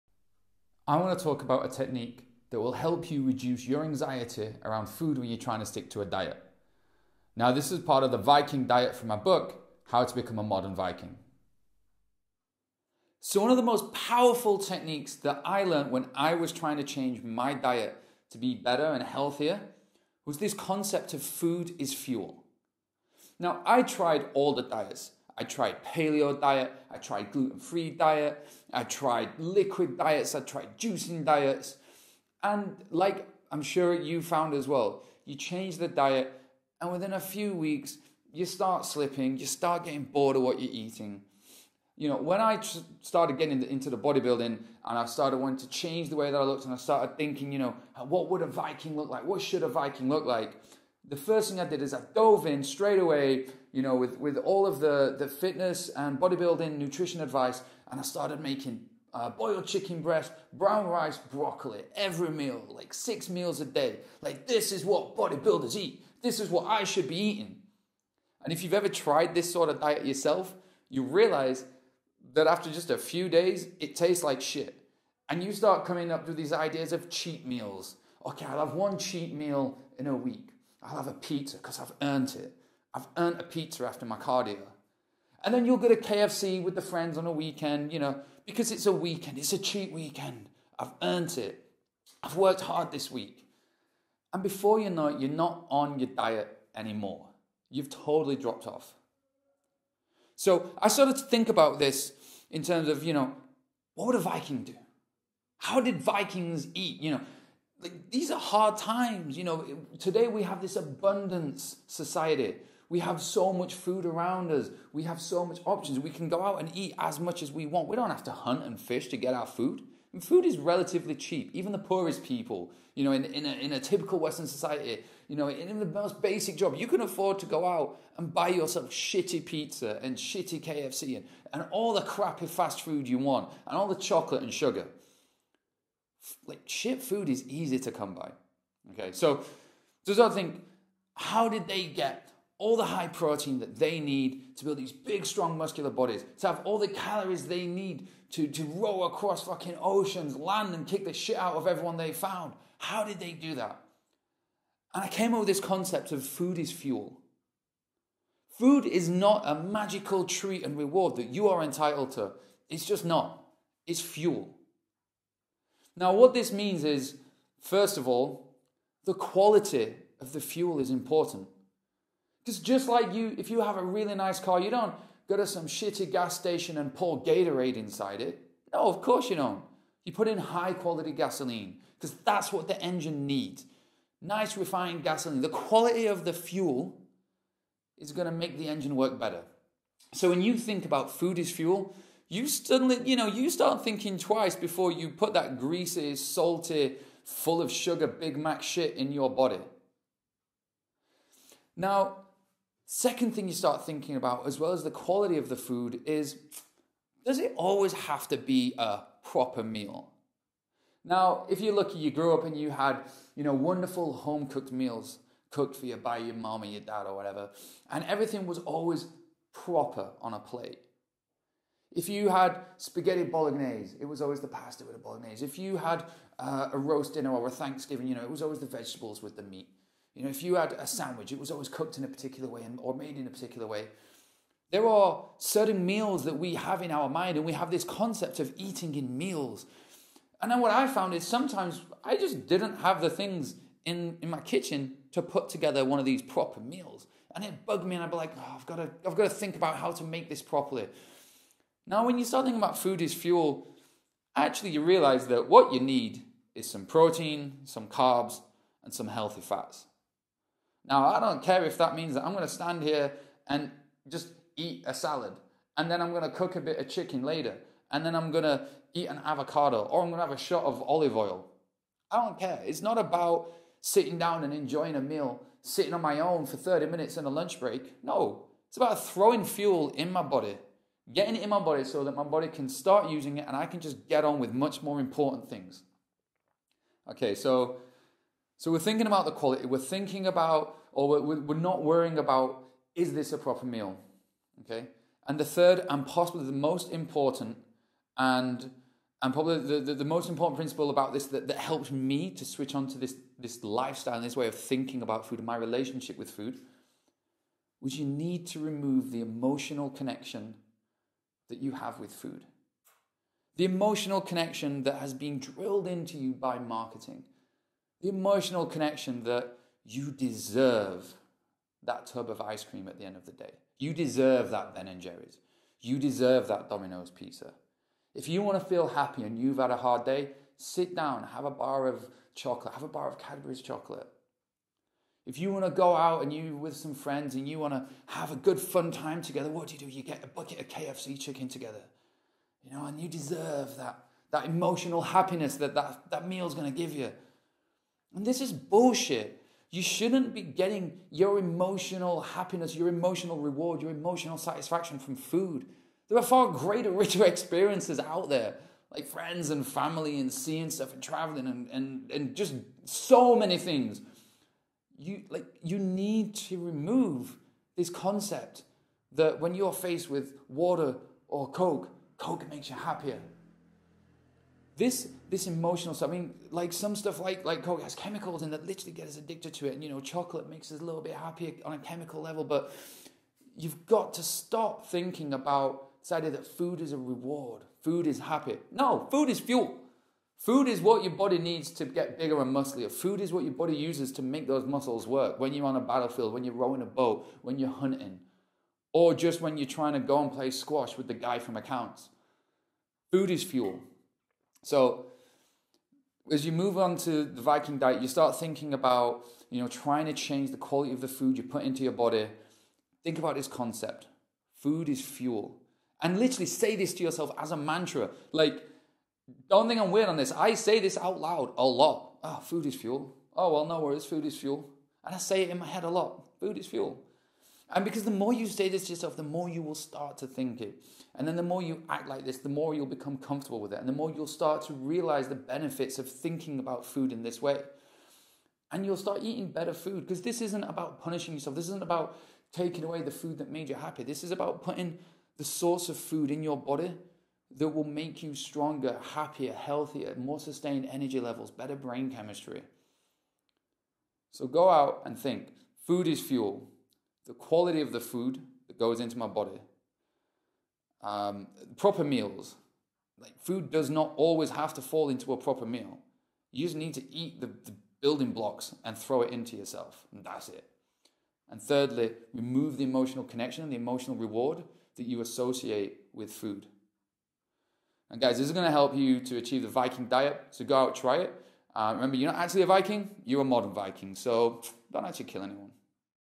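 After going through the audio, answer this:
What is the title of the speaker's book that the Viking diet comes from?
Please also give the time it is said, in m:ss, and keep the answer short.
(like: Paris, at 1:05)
How to Become a Modern Viking, at 0:09.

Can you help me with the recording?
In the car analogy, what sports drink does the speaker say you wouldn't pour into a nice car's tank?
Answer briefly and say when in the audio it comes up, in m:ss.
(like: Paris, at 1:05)
Gatorade, at 2:57.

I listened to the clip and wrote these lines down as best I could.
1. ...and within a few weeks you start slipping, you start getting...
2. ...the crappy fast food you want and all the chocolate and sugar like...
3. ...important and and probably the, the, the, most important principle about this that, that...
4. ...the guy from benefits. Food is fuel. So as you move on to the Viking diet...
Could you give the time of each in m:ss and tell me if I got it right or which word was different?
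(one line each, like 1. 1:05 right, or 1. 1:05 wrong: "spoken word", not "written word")
1. 0:36 right
2. 2:11 right
3. 4:56 right
4. 6:41 wrong: "accounts", not "benefits".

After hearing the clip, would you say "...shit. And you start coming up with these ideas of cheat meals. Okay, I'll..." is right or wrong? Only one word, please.
right.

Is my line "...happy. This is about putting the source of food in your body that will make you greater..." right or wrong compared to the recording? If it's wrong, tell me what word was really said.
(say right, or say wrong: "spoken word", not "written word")
wrong: "stronger", not "greater".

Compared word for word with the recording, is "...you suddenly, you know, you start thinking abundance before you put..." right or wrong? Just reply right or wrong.
wrong.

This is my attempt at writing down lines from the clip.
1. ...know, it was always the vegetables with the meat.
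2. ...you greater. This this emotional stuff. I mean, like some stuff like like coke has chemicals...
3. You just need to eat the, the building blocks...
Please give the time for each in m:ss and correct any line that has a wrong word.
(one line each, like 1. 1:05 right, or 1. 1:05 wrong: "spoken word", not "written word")
1. 3:48 right
2. 6:12 wrong: "happier", not "greater"
3. 7:46 right.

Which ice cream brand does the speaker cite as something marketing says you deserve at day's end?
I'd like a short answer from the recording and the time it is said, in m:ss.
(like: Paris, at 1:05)
Ben and Jerry's, at 5:24.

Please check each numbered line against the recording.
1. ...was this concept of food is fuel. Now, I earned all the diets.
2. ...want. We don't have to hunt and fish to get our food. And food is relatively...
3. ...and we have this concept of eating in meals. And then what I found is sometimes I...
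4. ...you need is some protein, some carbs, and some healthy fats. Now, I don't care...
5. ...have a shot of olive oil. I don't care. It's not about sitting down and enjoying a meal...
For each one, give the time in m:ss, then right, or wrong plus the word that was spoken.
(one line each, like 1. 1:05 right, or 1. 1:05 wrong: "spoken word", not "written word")
1. 0:20 wrong: "tried", not "earned"
2. 1:57 right
3. 3:57 right
4. 4:15 right
5. 4:30 right.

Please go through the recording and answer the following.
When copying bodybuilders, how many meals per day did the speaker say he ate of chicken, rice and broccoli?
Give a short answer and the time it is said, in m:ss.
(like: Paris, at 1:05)
6, at 1:02.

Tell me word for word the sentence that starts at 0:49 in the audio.
What should a Viking look like?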